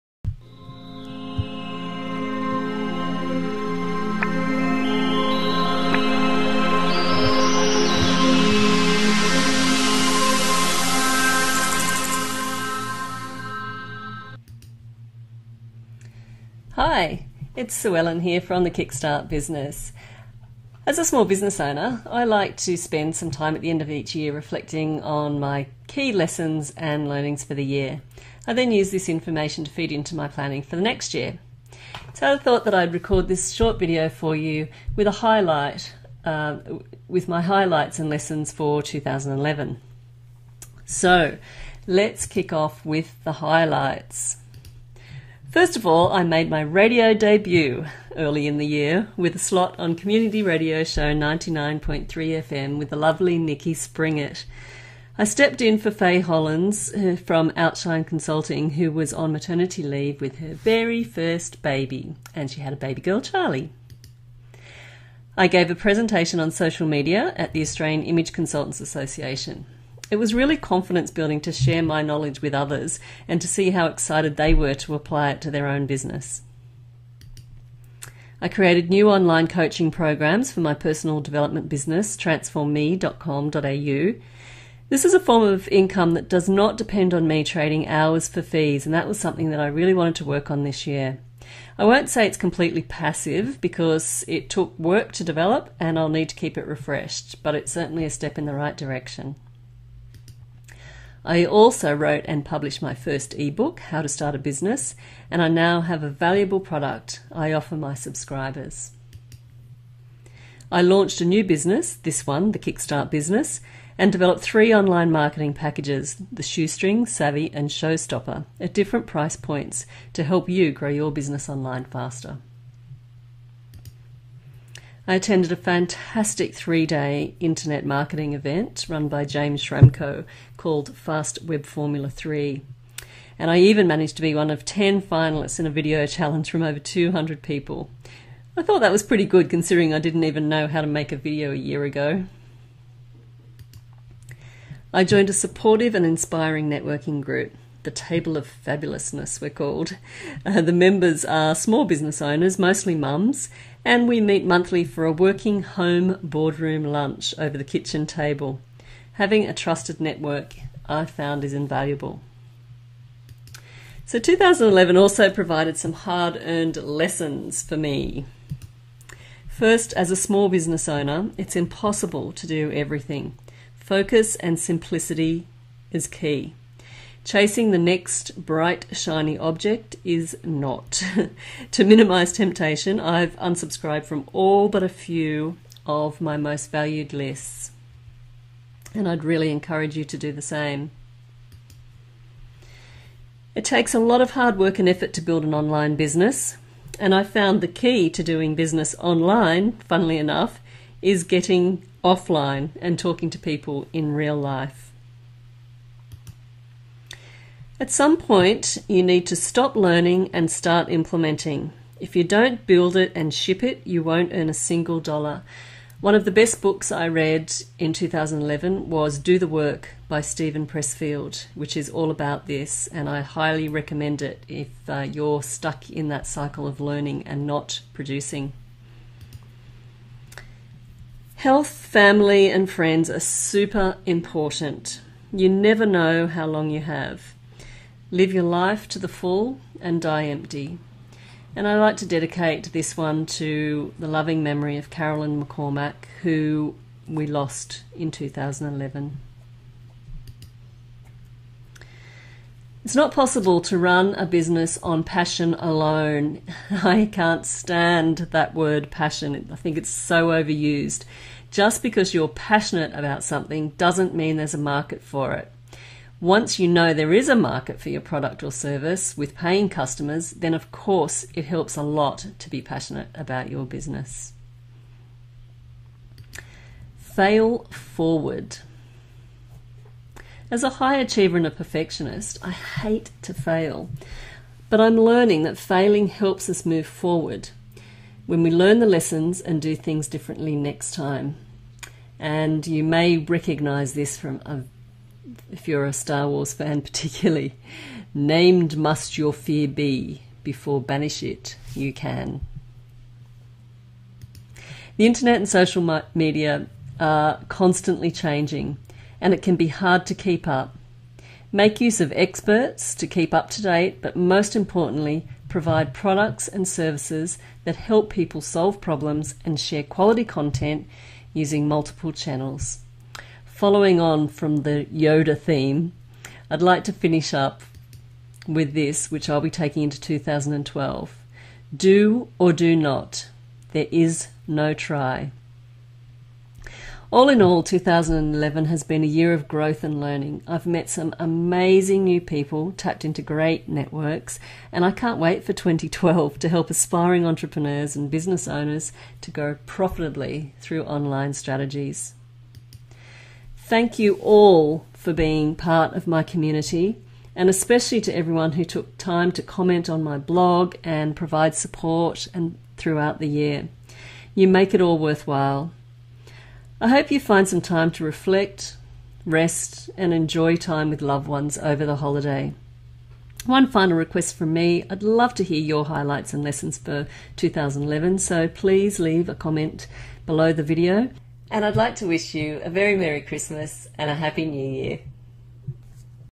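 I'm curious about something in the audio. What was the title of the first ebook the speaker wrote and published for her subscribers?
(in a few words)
How to Start a Business.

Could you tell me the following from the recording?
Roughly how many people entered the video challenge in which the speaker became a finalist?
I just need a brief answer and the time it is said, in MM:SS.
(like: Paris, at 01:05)
200, at 02:16.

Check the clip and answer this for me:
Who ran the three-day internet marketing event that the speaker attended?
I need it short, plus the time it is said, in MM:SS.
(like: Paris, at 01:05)
James Schramko, at 02:09.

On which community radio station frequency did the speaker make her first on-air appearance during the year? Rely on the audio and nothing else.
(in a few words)
99.3 FM.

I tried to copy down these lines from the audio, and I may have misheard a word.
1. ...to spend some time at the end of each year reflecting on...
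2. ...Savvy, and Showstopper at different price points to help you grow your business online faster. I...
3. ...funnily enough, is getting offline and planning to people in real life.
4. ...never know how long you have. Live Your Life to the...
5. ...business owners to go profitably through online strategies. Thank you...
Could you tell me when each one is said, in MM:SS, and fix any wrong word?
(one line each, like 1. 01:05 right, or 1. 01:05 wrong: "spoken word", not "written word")
1. 00:22 right
2. 01:57 right
3. 03:19 wrong: "talking", not "planning"
4. 03:55 right
5. 05:48 right.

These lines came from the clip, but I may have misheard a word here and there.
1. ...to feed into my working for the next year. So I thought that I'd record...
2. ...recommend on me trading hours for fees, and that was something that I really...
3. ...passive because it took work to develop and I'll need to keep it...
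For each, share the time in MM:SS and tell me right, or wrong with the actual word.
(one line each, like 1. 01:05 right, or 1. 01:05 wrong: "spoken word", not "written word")
1. 00:29 wrong: "planning", not "working"
2. 01:26 wrong: "depend", not "recommend"
3. 01:32 right.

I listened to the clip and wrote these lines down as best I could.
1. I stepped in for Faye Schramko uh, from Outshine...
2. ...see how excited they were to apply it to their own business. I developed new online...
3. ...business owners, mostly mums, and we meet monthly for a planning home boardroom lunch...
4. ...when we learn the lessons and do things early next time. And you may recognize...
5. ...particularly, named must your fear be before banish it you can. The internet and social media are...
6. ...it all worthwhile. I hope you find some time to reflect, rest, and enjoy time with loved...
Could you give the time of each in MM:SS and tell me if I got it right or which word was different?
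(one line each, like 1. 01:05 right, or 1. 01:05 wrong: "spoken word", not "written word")
1. 00:55 wrong: "Hollins", not "Schramko"
2. 01:13 wrong: "created", not "developed"
3. 02:31 wrong: "working", not "planning"
4. 04:48 wrong: "differently", not "early"
5. 04:56 right
6. 06:04 right.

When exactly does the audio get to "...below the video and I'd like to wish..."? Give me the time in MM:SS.
06:20.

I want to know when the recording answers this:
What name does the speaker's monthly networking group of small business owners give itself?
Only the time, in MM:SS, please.
02:27.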